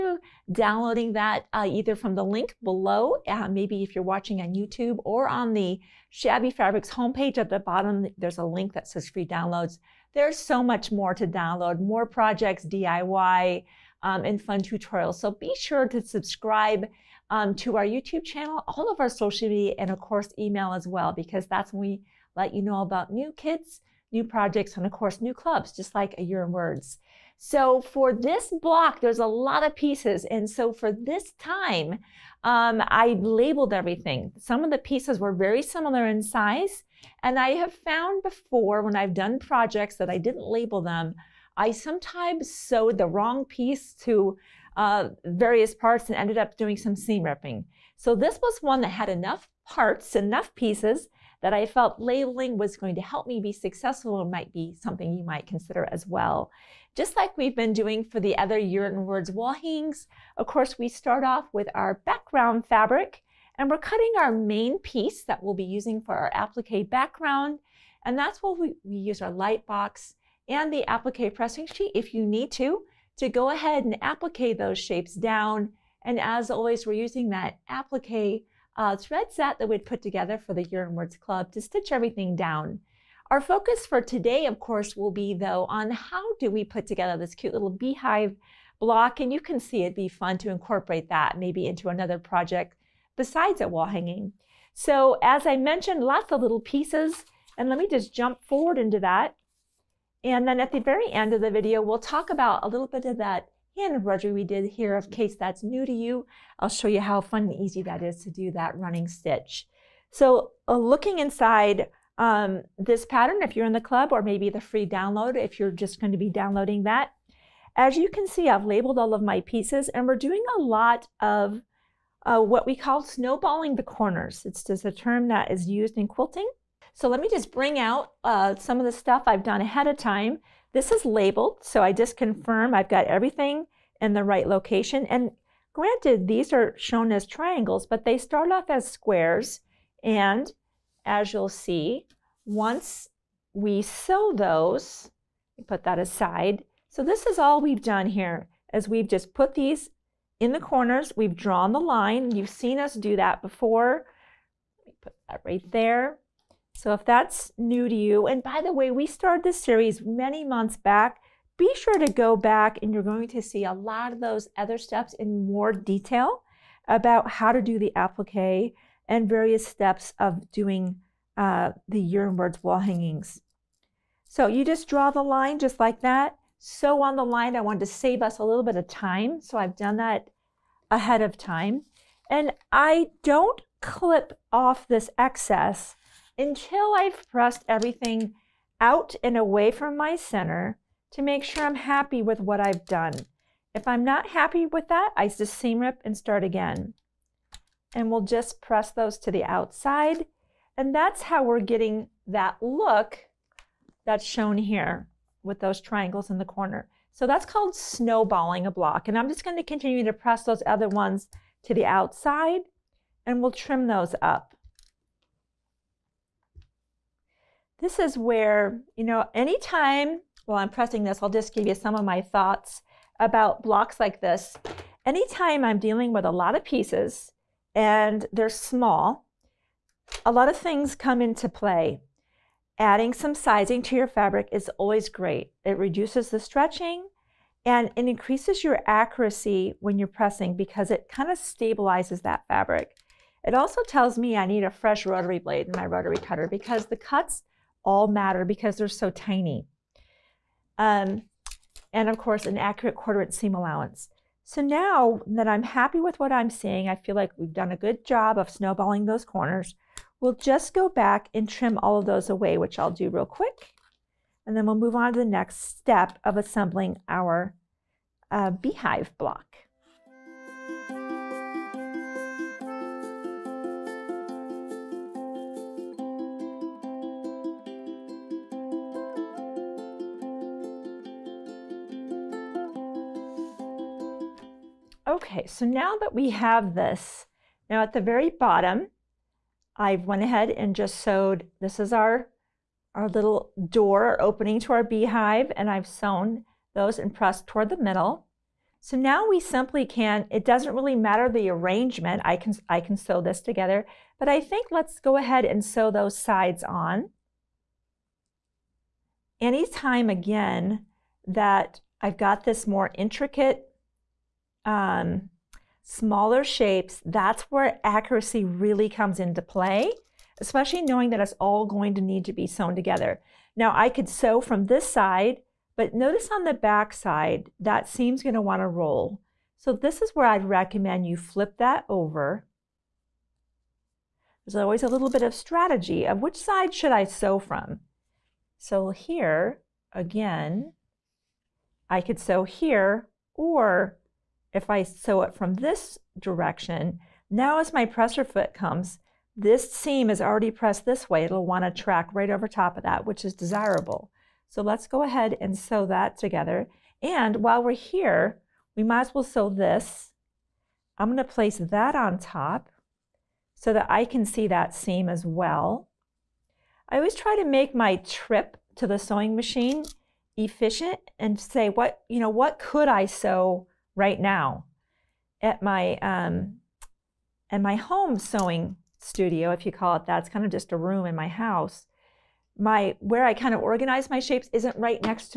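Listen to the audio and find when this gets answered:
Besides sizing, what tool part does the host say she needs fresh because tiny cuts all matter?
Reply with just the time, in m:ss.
4:05.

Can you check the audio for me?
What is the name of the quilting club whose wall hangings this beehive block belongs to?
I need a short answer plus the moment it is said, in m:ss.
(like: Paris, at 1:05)
A Year in Words, at 0:26.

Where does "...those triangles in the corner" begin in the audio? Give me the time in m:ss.
3:25.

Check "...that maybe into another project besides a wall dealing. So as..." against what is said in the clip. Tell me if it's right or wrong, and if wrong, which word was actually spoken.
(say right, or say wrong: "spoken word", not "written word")
wrong: "hanging", not "dealing".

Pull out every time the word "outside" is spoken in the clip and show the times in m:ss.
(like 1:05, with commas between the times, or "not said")
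3:19, 3:31.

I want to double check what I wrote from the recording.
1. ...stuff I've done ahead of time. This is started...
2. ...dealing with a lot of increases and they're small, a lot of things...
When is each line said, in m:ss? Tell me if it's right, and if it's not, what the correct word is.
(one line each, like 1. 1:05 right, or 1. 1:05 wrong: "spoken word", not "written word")
1. 2:08 wrong: "labeled", not "started"
2. 3:45 wrong: "pieces", not "increases".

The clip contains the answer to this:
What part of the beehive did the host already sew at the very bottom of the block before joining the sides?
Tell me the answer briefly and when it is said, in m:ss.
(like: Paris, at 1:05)
door or opening, at 4:53.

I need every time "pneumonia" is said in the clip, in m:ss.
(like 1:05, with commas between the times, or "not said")
not said.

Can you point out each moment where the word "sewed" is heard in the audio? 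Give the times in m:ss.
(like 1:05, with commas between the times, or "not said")
0:42, 4:50.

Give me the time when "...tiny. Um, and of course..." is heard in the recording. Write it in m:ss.
4:09.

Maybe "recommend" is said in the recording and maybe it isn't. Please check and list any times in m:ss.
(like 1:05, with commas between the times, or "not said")
5:30.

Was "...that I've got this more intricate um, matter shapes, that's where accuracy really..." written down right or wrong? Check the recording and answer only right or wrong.
wrong.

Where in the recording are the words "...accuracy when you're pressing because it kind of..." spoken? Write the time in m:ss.
3:58.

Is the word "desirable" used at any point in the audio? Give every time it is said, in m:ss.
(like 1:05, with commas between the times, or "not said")
5:53.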